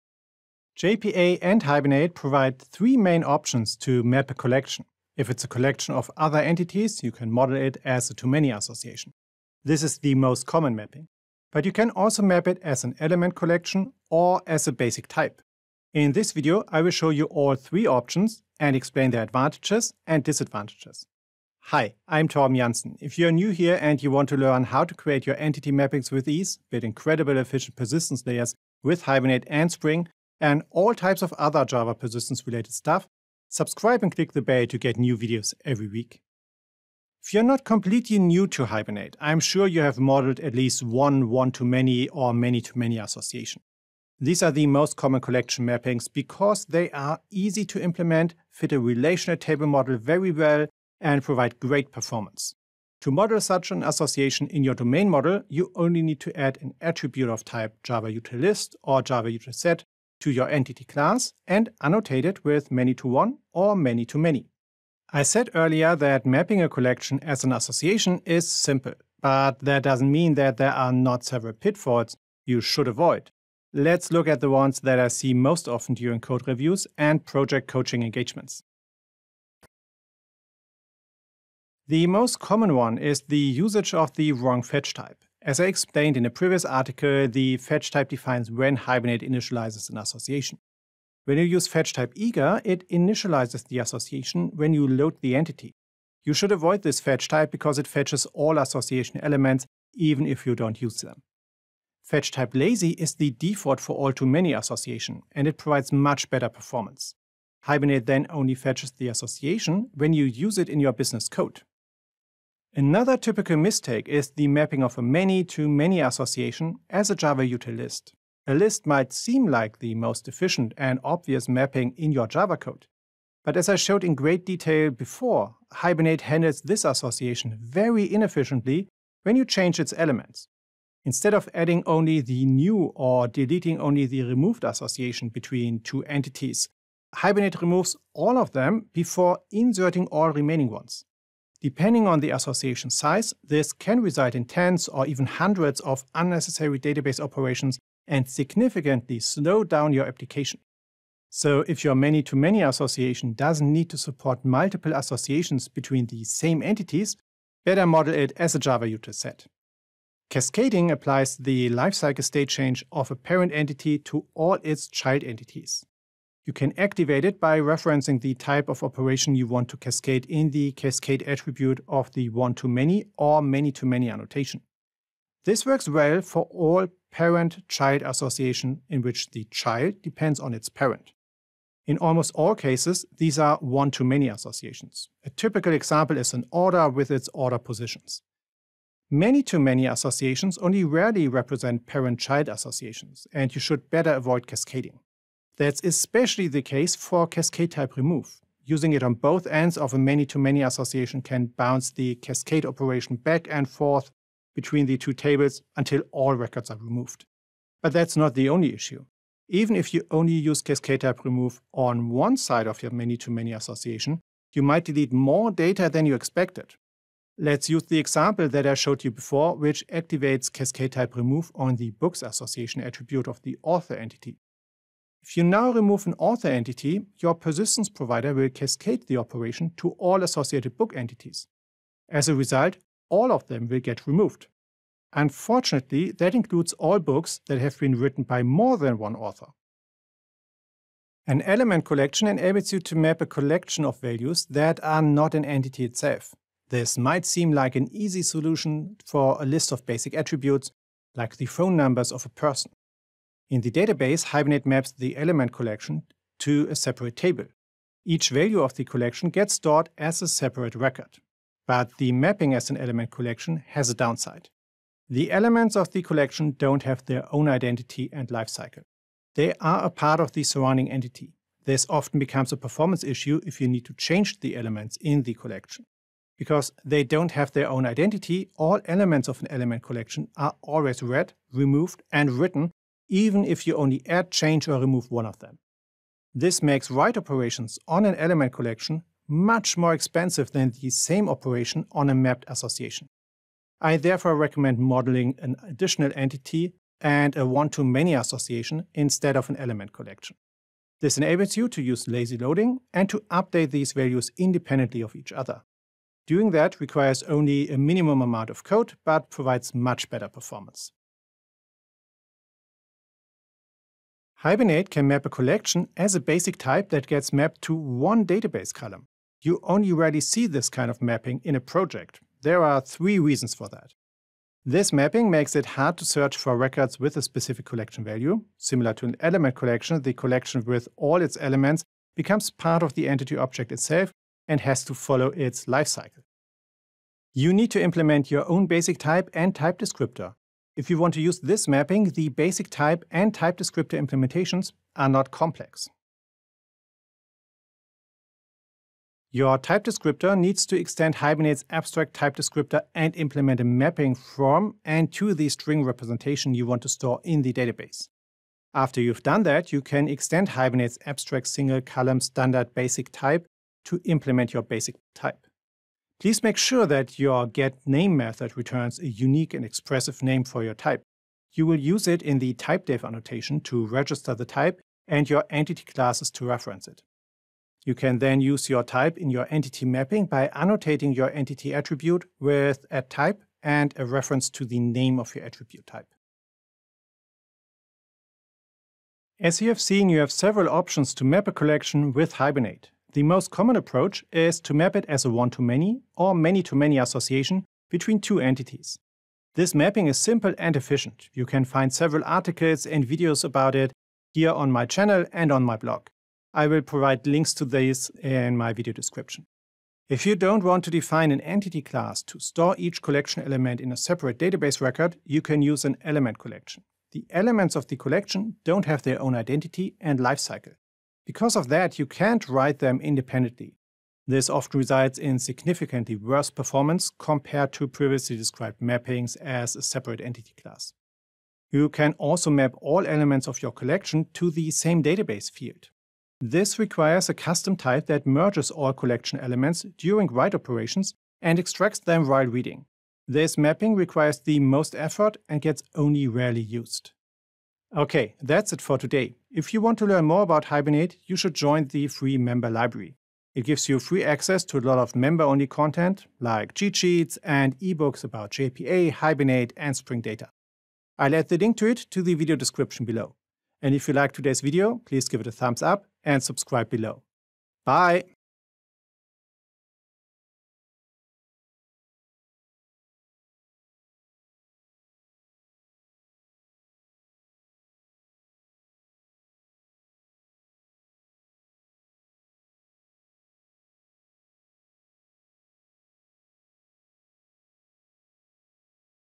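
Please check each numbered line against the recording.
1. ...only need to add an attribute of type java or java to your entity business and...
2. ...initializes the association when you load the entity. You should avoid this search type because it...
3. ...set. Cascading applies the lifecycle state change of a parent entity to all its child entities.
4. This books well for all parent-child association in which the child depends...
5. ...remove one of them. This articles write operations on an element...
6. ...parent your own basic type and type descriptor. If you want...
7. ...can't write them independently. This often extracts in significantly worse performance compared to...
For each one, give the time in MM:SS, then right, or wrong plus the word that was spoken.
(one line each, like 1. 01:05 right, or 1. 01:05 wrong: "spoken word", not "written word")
1. 00:55 wrong: "class", not "business"
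2. 01:32 wrong: "fetch", not "search"
3. 02:39 right
4. 02:55 wrong: "works", not "books"
5. 04:44 wrong: "makes", not "articles"
6. 05:37 wrong: "implement", not "parent"
7. 07:02 wrong: "results", not "extracts".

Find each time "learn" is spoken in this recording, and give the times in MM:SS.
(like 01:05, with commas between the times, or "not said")
00:24, 07:30.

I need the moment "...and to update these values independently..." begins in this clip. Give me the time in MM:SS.
05:02.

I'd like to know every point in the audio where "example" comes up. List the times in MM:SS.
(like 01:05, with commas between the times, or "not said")
03:05, 03:37.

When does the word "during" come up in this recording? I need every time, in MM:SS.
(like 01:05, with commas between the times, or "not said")
01:15, 07:19.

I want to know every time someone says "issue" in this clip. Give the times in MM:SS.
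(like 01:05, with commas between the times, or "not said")
03:28, 04:33.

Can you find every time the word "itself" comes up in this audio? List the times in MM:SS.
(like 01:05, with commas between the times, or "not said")
04:05, 05:33.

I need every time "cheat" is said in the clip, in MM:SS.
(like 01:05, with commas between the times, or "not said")
07:36.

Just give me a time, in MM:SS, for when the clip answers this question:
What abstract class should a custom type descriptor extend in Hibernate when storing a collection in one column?
05:51.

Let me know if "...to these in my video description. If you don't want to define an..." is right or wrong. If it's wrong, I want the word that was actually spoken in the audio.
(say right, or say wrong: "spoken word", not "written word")
right.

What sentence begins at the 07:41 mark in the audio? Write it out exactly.
I'll add the link to it to the video description below.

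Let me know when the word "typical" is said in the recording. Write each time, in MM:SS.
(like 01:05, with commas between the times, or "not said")
01:53, 03:05.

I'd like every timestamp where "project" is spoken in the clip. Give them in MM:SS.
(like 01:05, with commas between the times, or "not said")
01:17, 05:21.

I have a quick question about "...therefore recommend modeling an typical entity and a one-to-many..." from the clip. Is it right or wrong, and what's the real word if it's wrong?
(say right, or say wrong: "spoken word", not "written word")
wrong: "additional", not "typical".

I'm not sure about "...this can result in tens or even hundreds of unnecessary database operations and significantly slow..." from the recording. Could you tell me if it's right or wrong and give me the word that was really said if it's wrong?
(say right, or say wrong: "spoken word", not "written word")
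right.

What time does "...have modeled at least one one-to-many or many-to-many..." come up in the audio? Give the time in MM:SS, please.
00:39.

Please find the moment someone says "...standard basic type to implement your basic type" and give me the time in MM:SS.
06:02.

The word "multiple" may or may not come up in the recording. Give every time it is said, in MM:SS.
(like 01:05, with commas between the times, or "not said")
02:34.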